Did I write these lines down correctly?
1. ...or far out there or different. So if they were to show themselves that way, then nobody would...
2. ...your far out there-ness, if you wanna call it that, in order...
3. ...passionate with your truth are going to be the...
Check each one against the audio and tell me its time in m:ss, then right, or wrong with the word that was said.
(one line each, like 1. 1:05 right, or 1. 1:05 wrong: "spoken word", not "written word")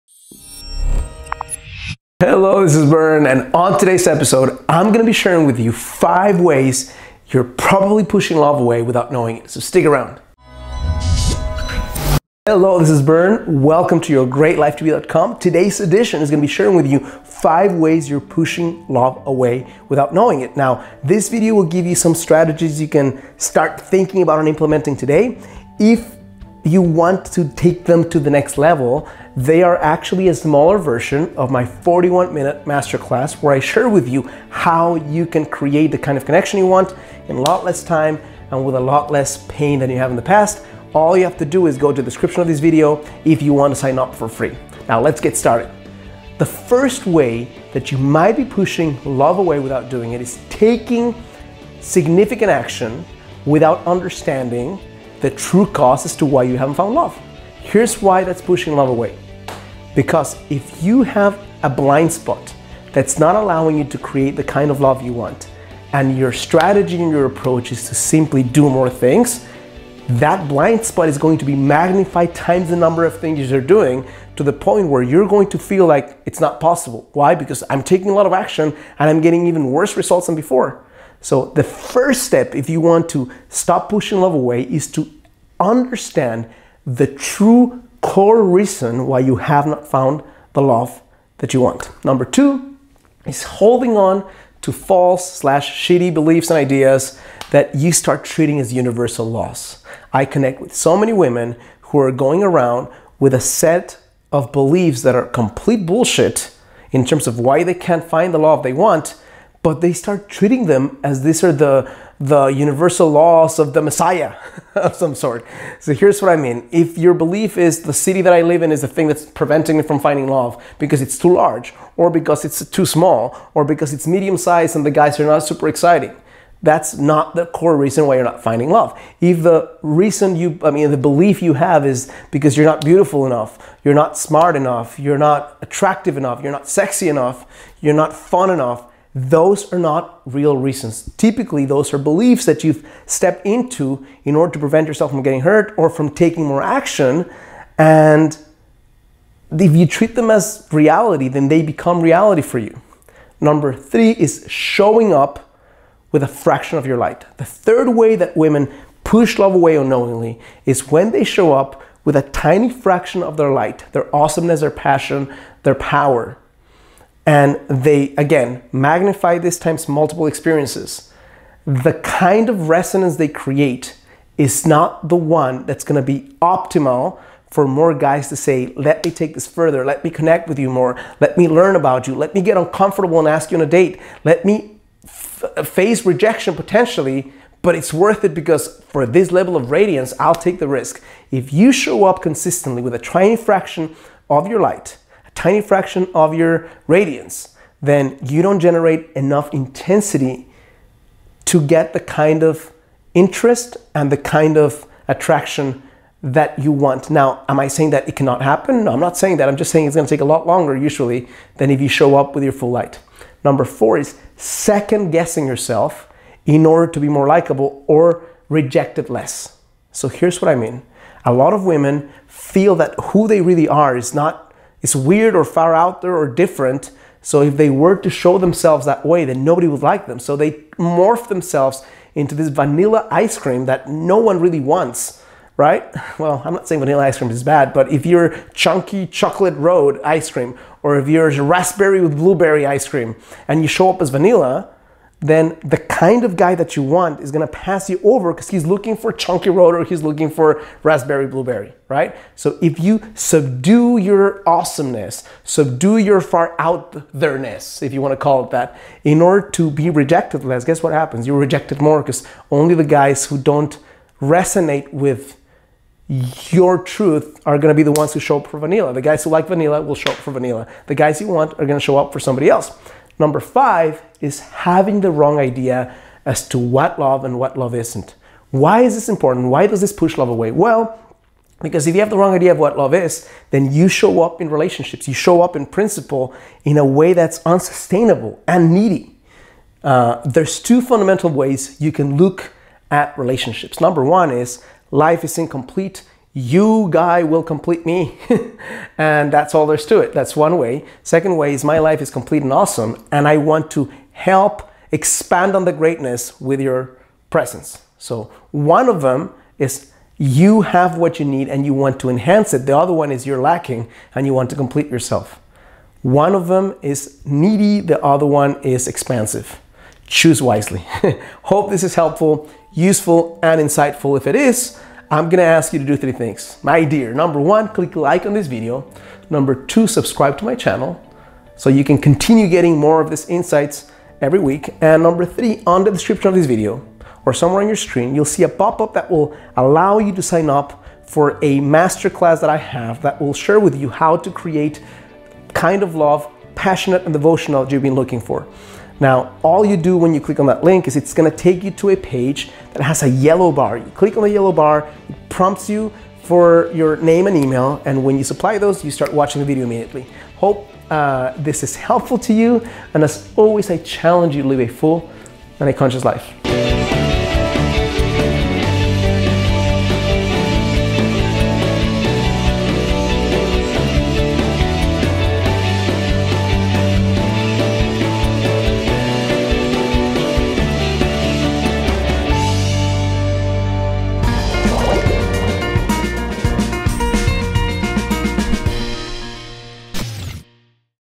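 1. 3:45 right
2. 4:15 right
3. 4:24 wrong: "resonate", not "passionate".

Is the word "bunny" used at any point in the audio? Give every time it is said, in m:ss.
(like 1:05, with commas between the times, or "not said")
not said.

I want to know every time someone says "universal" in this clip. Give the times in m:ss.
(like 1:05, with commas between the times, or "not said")
1:38, 1:52.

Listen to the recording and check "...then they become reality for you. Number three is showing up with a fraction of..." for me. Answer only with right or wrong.
right.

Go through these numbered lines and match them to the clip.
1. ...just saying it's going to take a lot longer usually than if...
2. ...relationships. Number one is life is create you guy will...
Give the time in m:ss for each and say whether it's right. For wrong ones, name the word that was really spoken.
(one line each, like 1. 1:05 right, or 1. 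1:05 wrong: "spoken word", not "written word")
1. 3:29 right
2. 4:53 wrong: "incomplete", not "create".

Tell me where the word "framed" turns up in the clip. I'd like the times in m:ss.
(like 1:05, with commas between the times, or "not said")
not said.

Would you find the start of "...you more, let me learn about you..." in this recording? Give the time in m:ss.
3:00.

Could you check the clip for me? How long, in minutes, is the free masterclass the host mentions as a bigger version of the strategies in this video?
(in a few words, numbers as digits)
41.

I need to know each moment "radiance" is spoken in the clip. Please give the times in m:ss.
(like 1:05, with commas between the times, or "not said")
3:09, 3:16.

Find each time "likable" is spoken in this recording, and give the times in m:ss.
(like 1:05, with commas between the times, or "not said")
3:37.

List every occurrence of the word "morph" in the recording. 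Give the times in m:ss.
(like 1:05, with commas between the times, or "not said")
3:50.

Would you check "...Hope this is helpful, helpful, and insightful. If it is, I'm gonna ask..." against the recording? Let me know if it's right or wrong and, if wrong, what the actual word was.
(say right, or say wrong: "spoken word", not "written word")
wrong: "useful", not "helpful".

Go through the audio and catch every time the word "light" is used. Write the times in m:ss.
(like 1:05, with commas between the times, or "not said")
2:36, 2:43, 3:14, 3:32.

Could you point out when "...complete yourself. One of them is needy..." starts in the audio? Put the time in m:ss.
5:14.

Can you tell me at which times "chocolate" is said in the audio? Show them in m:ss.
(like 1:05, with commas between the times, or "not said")
3:59.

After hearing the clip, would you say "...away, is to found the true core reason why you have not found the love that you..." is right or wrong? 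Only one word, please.
wrong.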